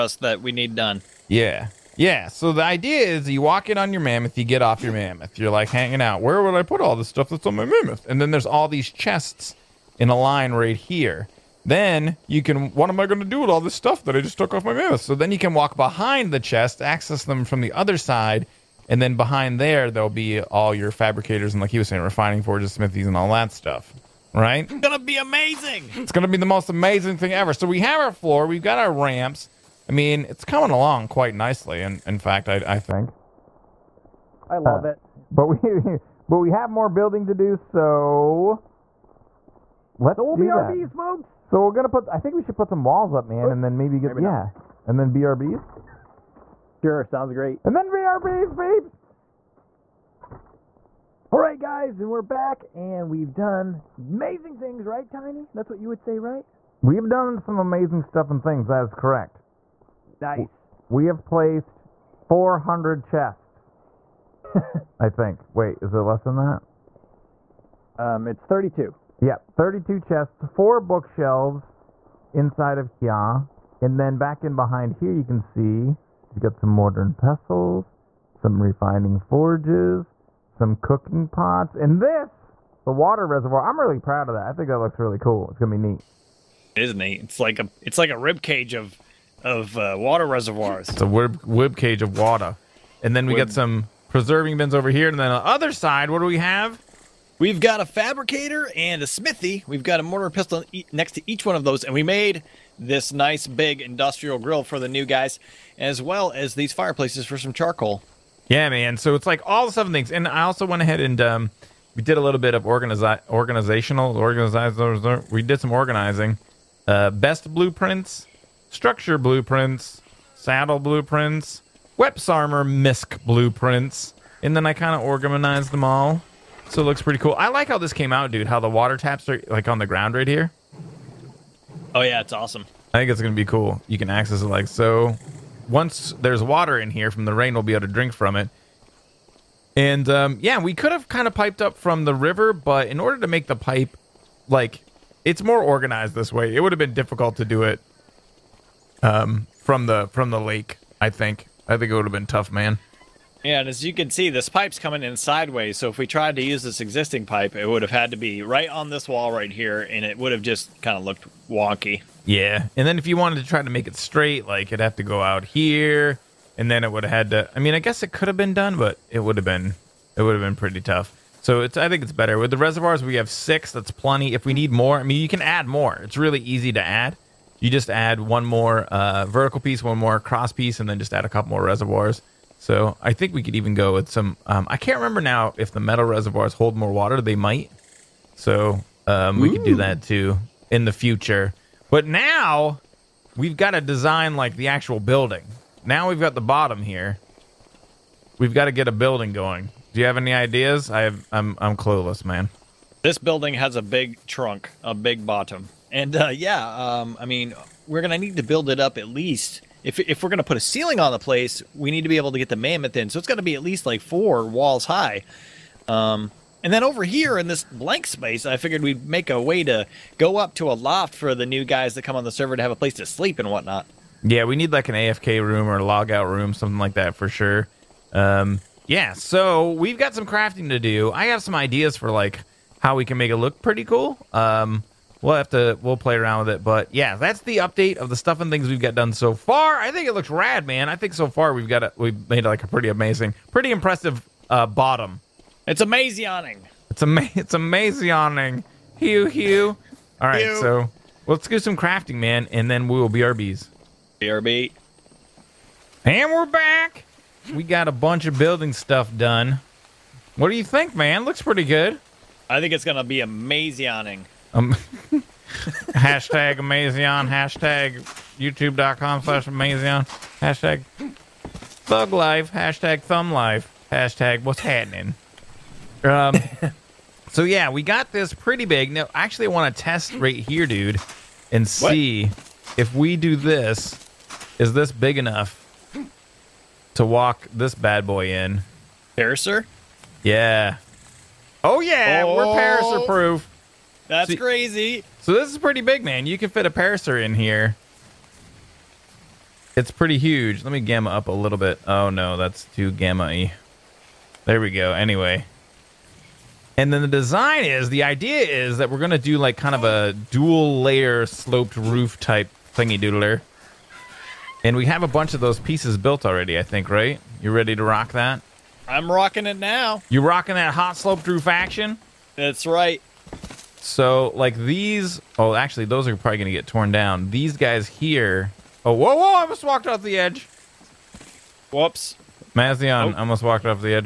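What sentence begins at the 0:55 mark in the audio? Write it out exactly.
That's what you would say, right?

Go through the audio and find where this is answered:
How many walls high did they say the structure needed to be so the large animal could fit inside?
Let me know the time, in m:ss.
3:34.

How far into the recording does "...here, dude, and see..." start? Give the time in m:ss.
4:40.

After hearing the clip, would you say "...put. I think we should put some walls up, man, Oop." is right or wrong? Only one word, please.
right.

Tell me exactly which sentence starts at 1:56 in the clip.
Uh, best blueprints, structure blueprints, saddle blueprints, Weps Armor misc blueprints, and then I kind of organized them all.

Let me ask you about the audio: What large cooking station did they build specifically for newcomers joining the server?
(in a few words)
industrial grill.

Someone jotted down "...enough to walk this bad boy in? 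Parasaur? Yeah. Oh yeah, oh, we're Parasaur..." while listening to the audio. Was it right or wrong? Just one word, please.
right.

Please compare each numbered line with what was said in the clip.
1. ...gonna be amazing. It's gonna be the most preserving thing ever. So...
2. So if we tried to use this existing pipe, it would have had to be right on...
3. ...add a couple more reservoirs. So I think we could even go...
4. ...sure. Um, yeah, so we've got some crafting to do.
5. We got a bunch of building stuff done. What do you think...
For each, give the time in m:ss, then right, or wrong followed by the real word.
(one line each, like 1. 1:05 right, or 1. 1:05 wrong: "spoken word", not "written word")
1. 0:24 wrong: "amazing", not "preserving"
2. 2:35 right
3. 3:01 right
4. 3:47 right
5. 4:17 right.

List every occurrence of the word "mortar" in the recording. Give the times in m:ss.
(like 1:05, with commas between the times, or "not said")
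1:16, 1:40.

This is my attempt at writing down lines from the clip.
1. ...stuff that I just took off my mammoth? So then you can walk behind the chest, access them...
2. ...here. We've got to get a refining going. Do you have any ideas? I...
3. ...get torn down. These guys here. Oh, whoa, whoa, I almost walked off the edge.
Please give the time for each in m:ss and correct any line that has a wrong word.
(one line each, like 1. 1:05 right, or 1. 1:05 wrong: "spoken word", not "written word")
1. 0:13 right
2. 3:16 wrong: "building", not "refining"
3. 5:26 right.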